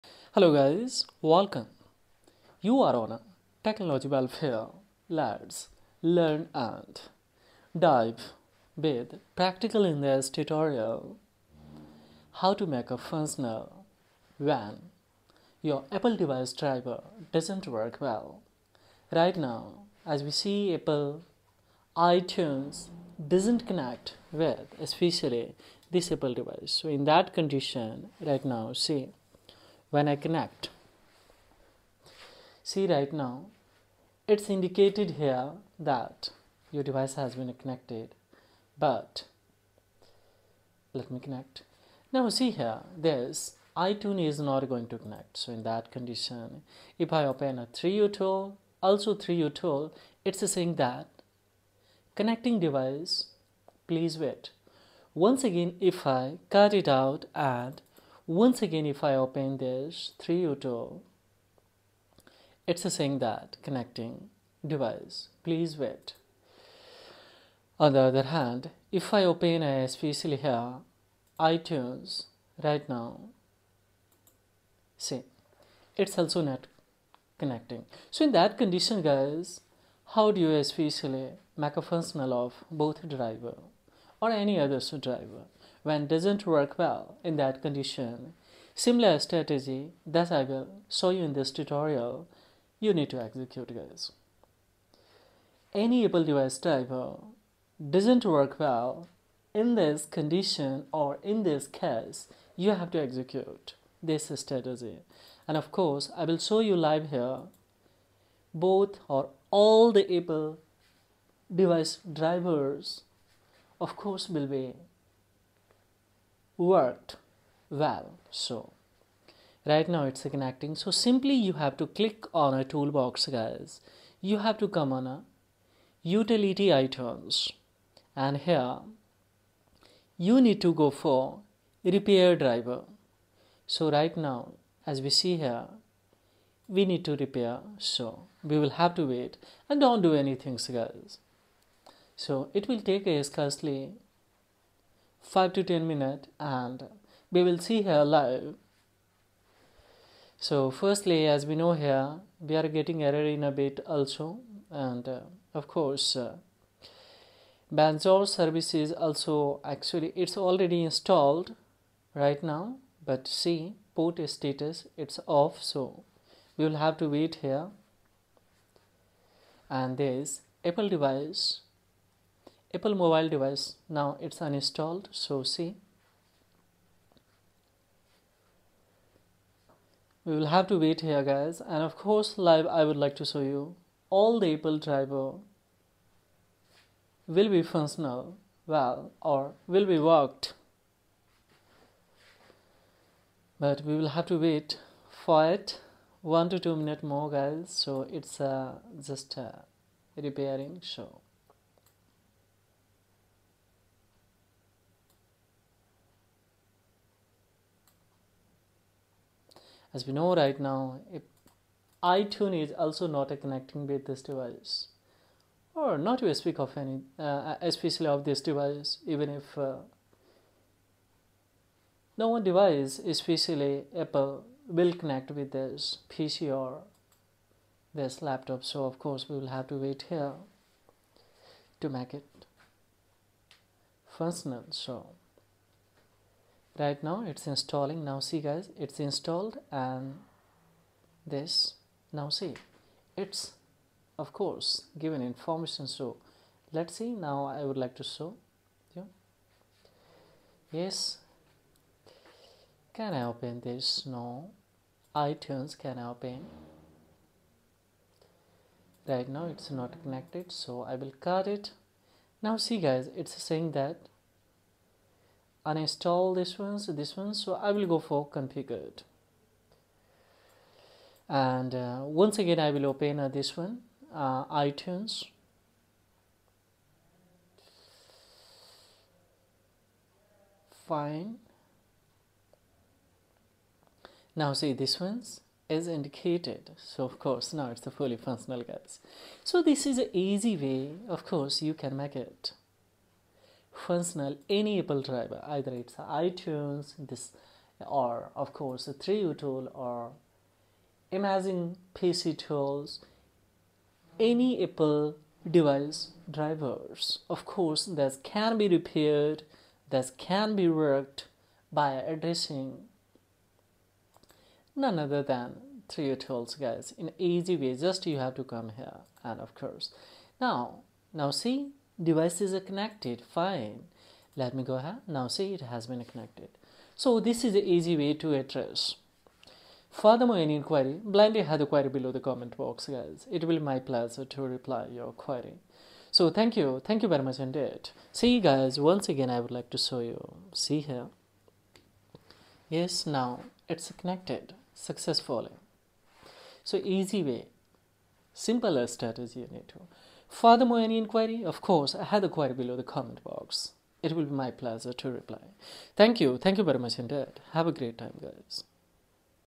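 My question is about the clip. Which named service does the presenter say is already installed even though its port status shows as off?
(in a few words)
Bonjour.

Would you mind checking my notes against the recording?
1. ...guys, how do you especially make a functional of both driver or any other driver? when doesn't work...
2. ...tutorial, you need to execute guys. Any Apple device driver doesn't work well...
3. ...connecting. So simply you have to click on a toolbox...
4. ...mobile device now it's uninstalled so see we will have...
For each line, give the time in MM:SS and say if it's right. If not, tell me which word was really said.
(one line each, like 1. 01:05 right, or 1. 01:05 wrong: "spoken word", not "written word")
1. 01:19 right
2. 01:31 right
3. 02:00 right
4. 02:52 right.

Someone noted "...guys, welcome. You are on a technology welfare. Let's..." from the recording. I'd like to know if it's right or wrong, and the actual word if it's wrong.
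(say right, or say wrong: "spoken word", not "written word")
right.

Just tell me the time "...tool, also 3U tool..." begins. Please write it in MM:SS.
00:48.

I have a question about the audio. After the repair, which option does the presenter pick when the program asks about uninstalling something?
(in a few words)
configured.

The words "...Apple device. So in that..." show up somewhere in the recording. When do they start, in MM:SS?
00:26.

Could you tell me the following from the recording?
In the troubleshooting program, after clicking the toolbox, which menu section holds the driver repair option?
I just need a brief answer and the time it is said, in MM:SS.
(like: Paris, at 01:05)
utility items, at 02:06.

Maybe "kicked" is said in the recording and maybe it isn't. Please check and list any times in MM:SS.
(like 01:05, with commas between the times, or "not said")
not said.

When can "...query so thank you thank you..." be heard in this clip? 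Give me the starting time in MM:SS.
05:35.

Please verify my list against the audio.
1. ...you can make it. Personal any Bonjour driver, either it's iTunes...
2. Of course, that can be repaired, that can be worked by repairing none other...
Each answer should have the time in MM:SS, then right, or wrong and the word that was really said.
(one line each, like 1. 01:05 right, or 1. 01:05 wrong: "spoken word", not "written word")
1. 04:51 wrong: "Apple", not "Bonjour"
2. 05:07 wrong: "addressing", not "repairing".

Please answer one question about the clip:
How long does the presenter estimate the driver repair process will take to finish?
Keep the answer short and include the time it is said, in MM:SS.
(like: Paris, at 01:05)
5 to 10 minutes, at 02:25.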